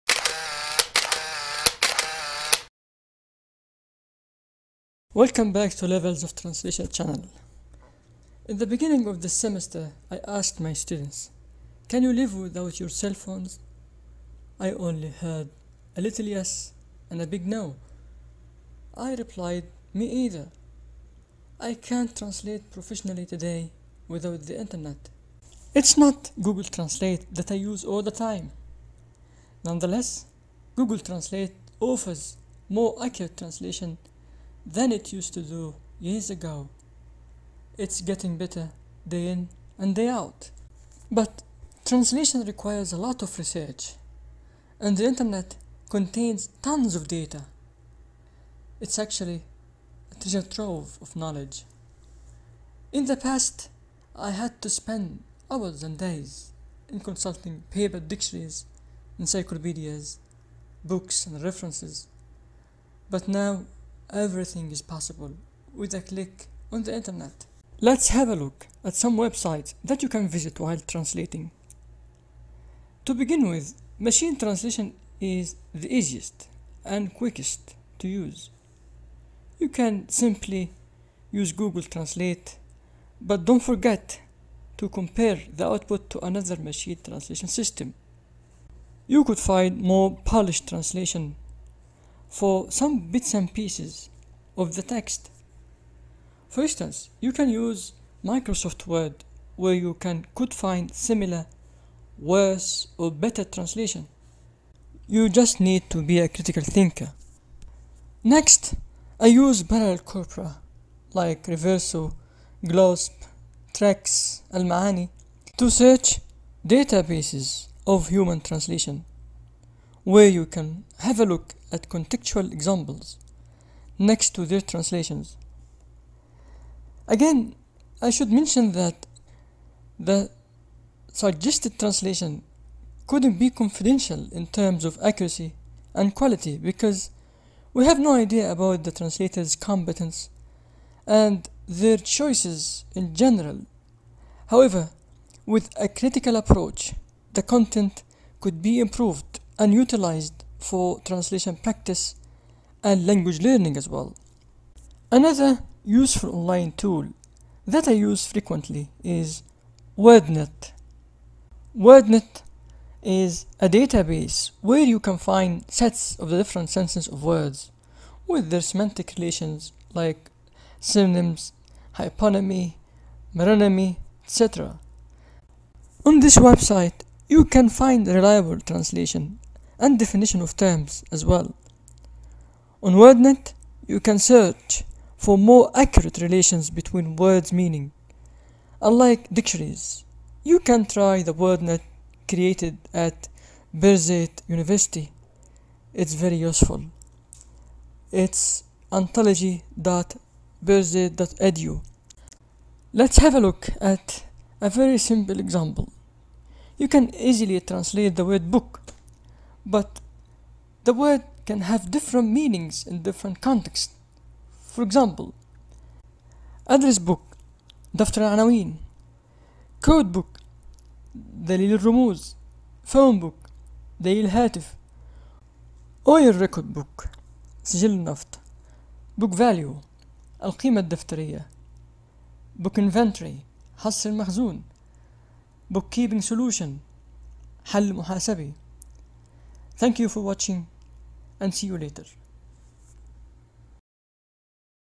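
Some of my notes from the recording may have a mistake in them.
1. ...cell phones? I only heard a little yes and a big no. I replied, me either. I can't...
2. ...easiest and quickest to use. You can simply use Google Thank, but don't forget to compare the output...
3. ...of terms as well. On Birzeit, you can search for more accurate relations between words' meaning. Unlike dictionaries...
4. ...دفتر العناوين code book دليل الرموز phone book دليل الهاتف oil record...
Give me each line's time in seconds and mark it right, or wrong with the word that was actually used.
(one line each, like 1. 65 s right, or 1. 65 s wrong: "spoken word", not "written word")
1. 12 s right
2. 75 s wrong: "Translate", not "Thank"
3. 180 s wrong: "WordNet", not "Birzeit"
4. 217 s right.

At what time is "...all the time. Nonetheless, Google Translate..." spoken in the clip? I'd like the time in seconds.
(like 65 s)
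27 s.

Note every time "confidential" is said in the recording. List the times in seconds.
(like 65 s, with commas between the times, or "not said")
133 s.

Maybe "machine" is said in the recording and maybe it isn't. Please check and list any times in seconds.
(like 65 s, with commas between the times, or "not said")
73 s, 86 s.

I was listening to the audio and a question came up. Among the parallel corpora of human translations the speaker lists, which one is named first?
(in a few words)
Reverso.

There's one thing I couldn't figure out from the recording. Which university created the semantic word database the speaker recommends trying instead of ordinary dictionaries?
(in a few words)
Birzeit University.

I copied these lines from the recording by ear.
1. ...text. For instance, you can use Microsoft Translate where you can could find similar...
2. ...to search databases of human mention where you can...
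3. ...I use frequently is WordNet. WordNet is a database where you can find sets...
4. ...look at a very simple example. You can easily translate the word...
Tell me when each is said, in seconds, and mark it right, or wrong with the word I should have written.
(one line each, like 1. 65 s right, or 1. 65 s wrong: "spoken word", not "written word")
1. 94 s wrong: "Word", not "Translate"
2. 115 s wrong: "translation", not "mention"
3. 157 s right
4. 203 s right.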